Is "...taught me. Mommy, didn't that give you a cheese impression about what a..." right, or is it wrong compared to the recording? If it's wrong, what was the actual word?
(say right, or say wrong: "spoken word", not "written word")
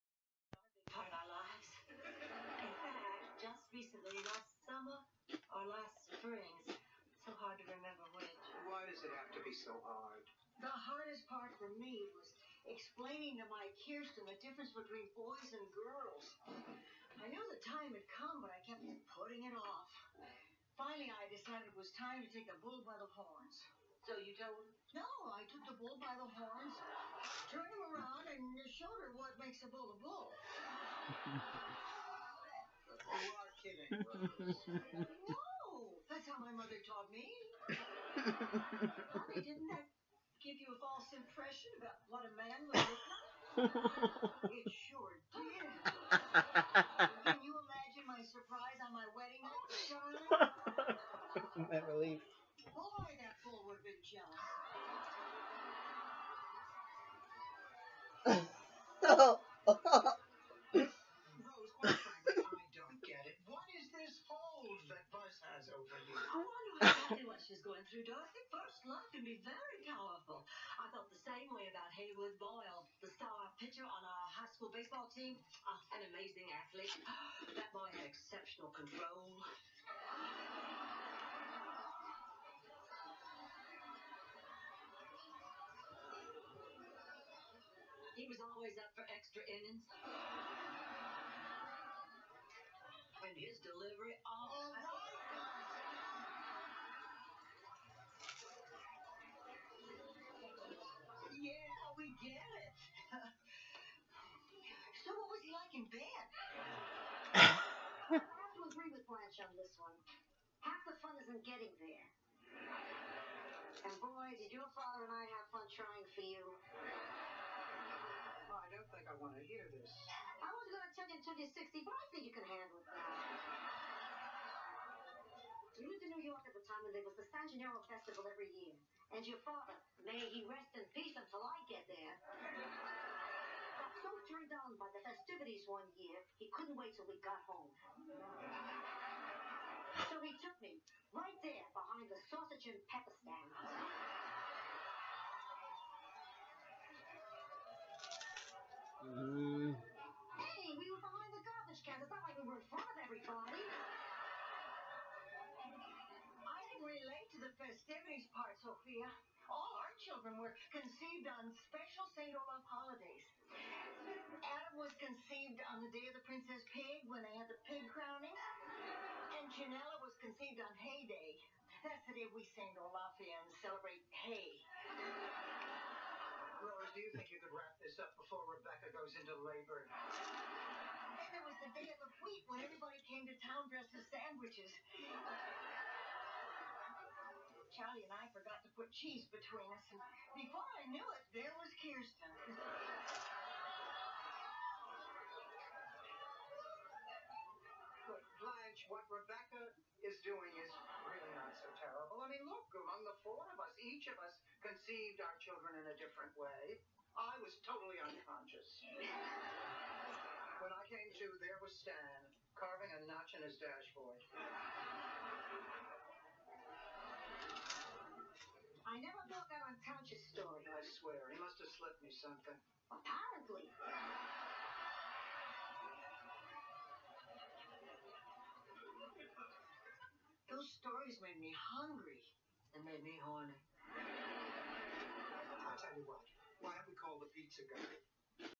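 wrong: "false", not "cheese".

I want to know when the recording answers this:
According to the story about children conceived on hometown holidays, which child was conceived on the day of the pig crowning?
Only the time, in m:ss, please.
2:44.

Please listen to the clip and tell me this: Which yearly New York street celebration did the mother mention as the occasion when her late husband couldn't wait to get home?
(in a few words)
San Gennaro Festival.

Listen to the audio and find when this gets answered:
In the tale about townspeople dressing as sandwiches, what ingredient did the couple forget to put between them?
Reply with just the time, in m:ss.
3:08.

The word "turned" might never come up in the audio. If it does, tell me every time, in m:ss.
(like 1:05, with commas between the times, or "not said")
0:27, 2:14.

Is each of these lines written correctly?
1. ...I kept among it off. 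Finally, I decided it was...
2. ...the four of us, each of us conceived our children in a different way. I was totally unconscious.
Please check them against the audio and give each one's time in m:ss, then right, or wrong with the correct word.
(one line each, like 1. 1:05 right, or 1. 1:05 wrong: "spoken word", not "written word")
1. 0:18 wrong: "putting", not "among"
2. 3:23 right.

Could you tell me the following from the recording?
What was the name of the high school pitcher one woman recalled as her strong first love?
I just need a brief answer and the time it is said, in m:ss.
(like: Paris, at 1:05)
Haywood Boyle, at 1:11.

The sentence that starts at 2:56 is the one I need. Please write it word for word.
Rose, do you think you could wrap this up before Rebecca goes into labor?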